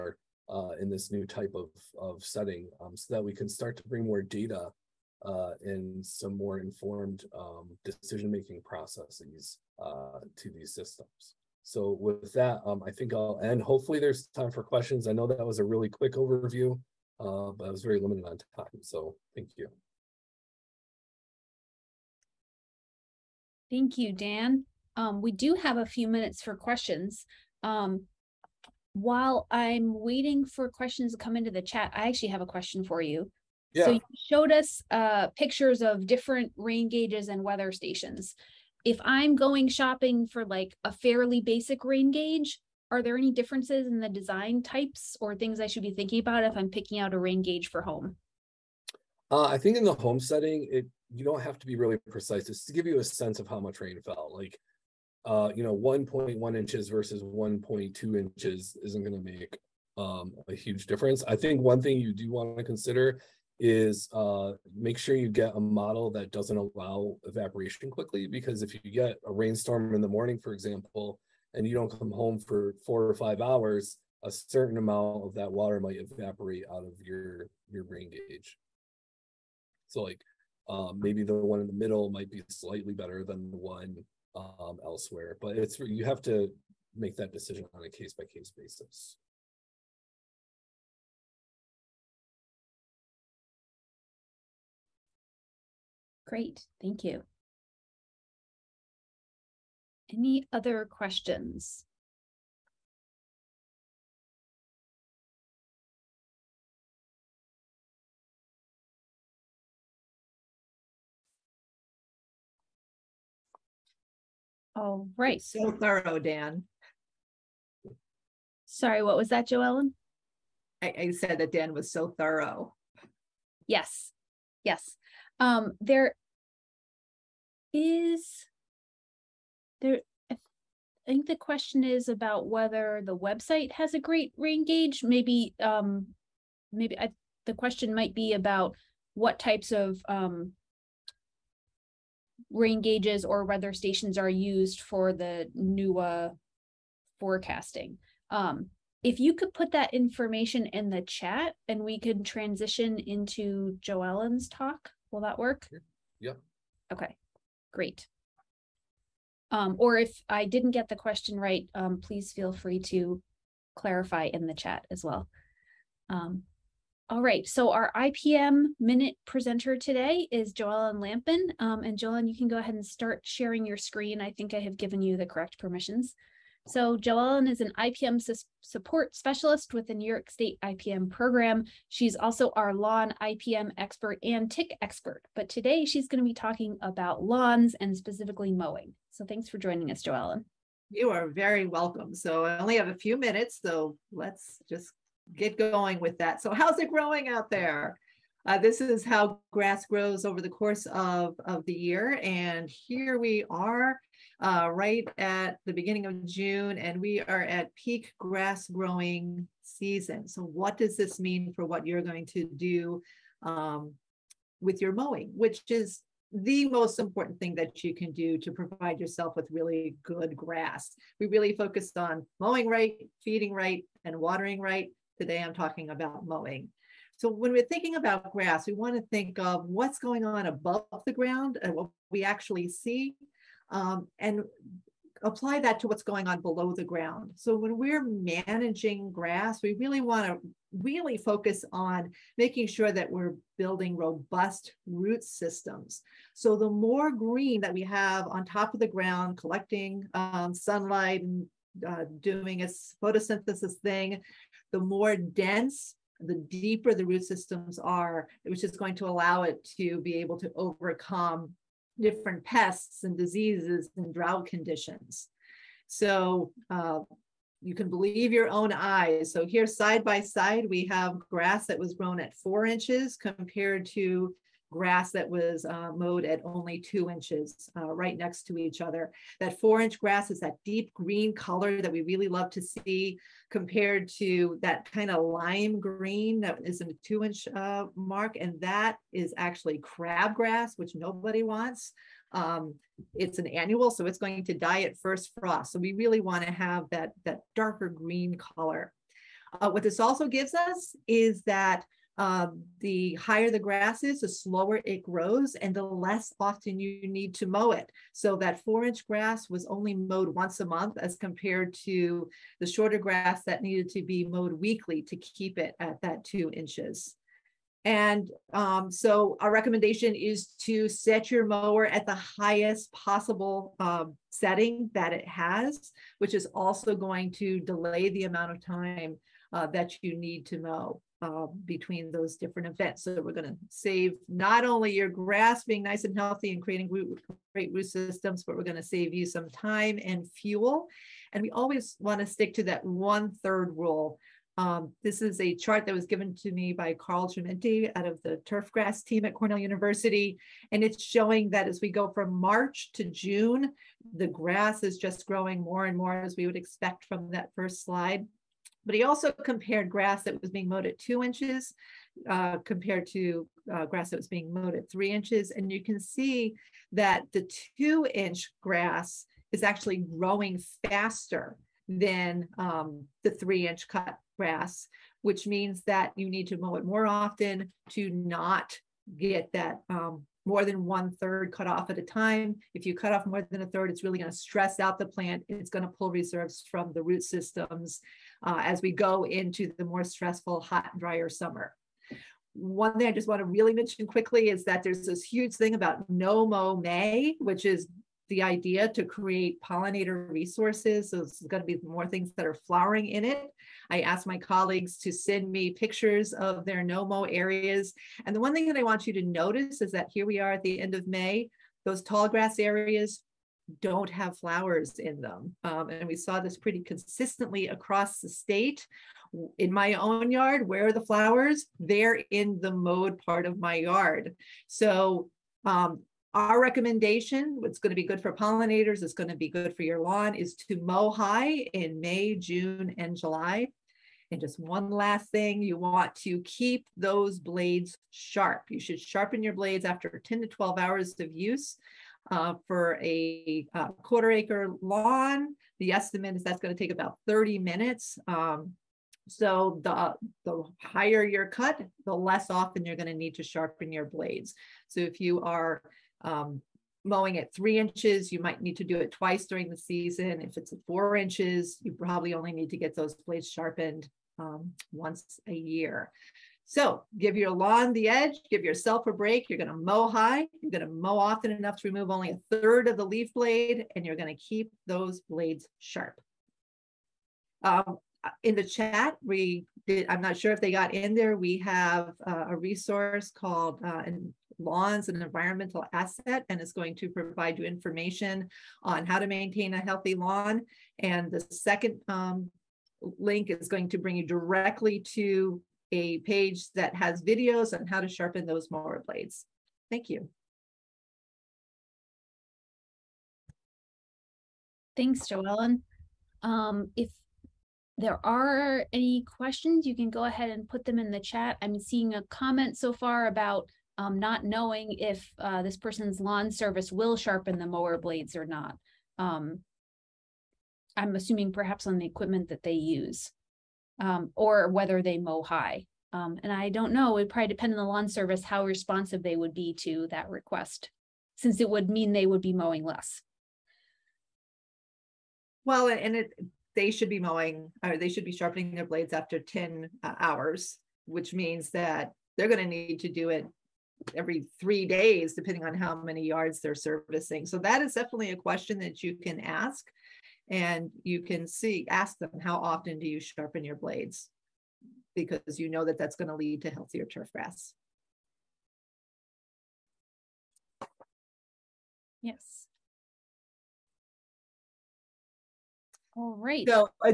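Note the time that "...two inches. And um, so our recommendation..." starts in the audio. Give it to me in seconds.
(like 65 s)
316 s.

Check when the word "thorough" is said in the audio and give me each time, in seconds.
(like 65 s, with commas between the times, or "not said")
115 s, 122 s.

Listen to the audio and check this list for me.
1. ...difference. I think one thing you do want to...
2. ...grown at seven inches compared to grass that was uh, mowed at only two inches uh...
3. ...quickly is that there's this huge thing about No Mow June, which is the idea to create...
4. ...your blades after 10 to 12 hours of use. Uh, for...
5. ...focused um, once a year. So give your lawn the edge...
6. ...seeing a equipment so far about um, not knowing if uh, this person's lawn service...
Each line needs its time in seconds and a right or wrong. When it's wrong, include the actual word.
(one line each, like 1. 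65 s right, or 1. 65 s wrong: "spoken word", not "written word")
1. 60 s right
2. 271 s wrong: "four", not "seven"
3. 394 s wrong: "May", not "June"
4. 439 s right
5. 463 s wrong: "sharpened", not "focused"
6. 511 s wrong: "comment", not "equipment".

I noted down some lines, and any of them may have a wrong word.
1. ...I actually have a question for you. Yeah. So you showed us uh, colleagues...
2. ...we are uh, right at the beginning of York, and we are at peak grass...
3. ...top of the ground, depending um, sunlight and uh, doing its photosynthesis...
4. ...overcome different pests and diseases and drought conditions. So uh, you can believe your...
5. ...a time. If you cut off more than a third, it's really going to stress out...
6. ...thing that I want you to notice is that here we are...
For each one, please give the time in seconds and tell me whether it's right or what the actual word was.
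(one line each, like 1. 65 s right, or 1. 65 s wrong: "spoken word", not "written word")
1. 31 s wrong: "pictures", not "colleagues"
2. 203 s wrong: "June", not "York"
3. 248 s wrong: "collecting", not "depending"
4. 260 s right
5. 381 s right
6. 408 s right.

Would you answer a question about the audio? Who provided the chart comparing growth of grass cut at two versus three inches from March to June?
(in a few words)
Carl Gementi.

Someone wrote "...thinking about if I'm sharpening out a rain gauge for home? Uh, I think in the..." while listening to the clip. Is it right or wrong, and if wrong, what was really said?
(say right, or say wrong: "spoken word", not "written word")
wrong: "picking", not "sharpening".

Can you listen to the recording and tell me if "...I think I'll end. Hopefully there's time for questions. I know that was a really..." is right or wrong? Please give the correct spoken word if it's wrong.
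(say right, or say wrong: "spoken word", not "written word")
right.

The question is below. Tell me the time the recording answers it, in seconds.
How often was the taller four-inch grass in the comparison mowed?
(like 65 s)
310 s.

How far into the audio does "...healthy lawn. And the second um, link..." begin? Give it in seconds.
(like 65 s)
489 s.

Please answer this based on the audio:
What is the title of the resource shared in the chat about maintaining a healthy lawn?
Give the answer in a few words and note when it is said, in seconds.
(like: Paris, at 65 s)
Lawns an Environmental Asset, at 484 s.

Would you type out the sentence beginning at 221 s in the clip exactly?
We really focused on mowing right, feeding right, and watering right Today I'm talking about mowing.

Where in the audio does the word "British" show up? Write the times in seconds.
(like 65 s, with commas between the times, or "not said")
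not said.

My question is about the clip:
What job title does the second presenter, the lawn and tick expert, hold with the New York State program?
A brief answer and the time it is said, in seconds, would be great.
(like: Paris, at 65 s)
IPM support specialist, at 177 s.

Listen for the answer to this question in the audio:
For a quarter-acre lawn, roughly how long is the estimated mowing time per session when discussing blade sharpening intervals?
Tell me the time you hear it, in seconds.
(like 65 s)
447 s.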